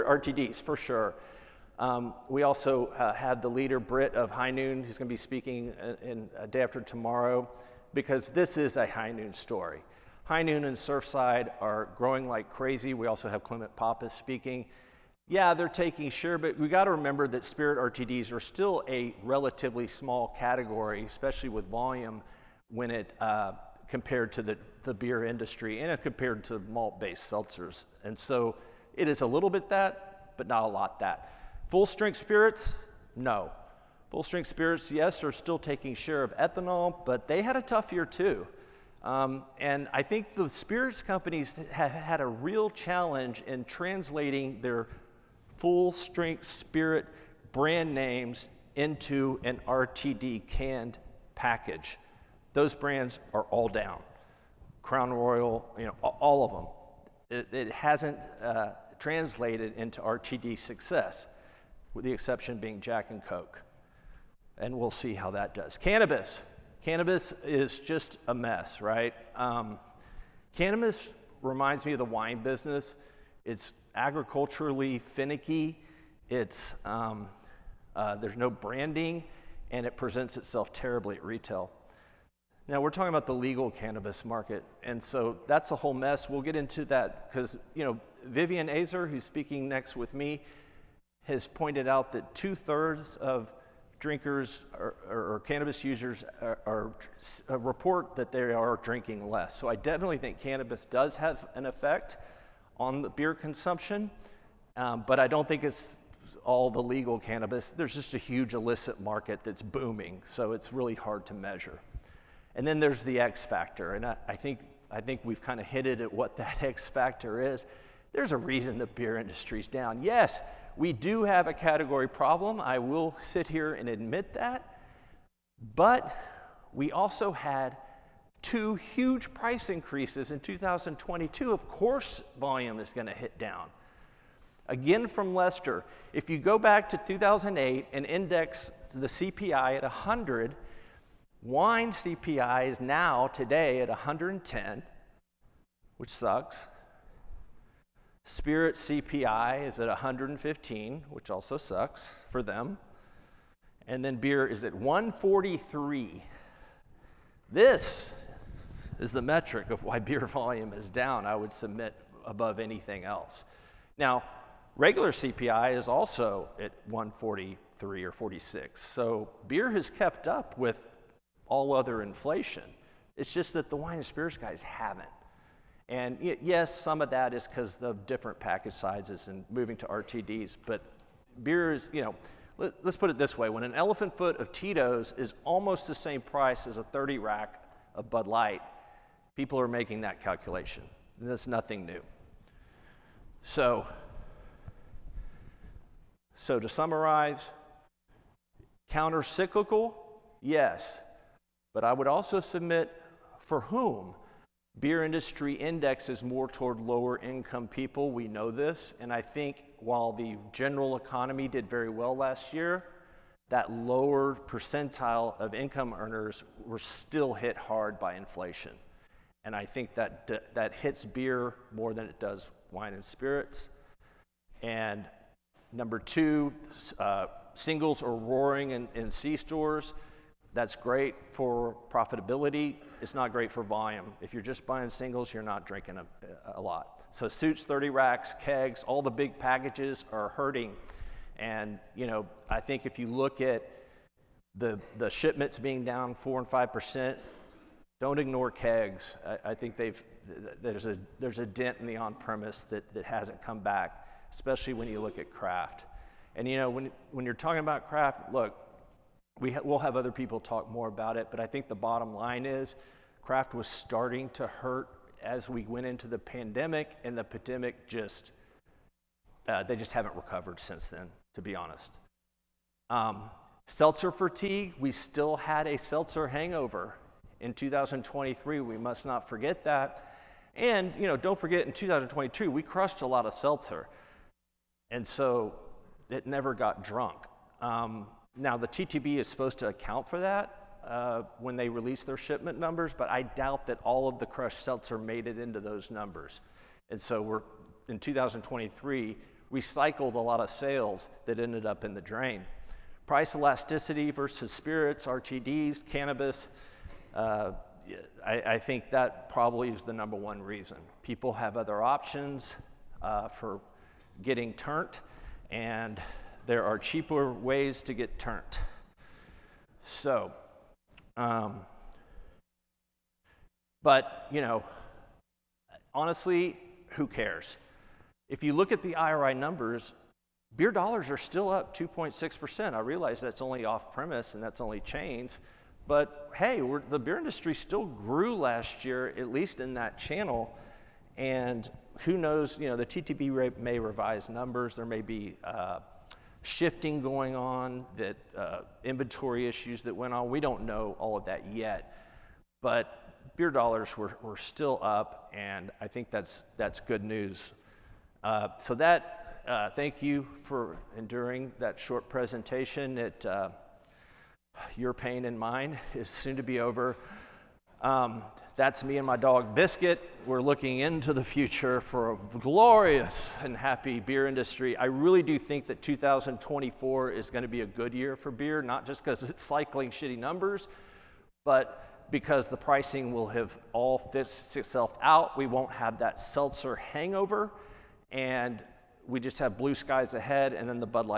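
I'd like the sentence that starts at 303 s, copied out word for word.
Price elasticity versus spirits, RTDs, cannabis, uh, I, I, think that probably is the number one reason.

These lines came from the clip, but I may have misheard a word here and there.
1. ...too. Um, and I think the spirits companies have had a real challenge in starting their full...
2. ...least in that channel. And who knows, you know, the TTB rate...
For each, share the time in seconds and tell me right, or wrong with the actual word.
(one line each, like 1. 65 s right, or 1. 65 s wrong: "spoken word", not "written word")
1. 38 s wrong: "translating", not "starting"
2. 339 s right.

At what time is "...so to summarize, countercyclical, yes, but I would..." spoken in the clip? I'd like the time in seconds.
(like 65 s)
196 s.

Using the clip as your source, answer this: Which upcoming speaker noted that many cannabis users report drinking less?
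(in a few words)
Vivian Azer.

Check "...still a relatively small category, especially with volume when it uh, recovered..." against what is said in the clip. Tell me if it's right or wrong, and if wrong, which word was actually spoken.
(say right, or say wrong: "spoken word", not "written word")
wrong: "compared", not "recovered".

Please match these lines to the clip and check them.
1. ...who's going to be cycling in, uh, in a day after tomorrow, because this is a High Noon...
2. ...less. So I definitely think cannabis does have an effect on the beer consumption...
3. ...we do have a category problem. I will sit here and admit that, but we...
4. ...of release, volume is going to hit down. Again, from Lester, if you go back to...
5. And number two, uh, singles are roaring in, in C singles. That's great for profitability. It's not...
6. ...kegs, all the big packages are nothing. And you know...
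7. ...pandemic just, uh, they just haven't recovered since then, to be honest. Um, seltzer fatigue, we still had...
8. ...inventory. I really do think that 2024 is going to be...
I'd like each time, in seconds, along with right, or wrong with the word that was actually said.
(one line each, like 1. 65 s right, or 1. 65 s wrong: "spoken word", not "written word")
1. 4 s wrong: "speaking", not "cycling"
2. 99 s right
3. 120 s right
4. 131 s wrong: "course", not "release"
5. 224 s wrong: "stores", not "singles"
6. 238 s wrong: "hurting", not "nothing"
7. 267 s right
8. 374 s wrong: "industry", not "inventory".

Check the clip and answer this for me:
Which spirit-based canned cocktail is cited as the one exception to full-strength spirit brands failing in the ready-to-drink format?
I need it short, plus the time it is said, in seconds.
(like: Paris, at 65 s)
Jack and Coke, at 62 s.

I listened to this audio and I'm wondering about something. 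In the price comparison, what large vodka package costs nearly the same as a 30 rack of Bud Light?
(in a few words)
elephant foot of Tito's.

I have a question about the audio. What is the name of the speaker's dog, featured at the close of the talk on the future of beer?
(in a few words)
Biscuit.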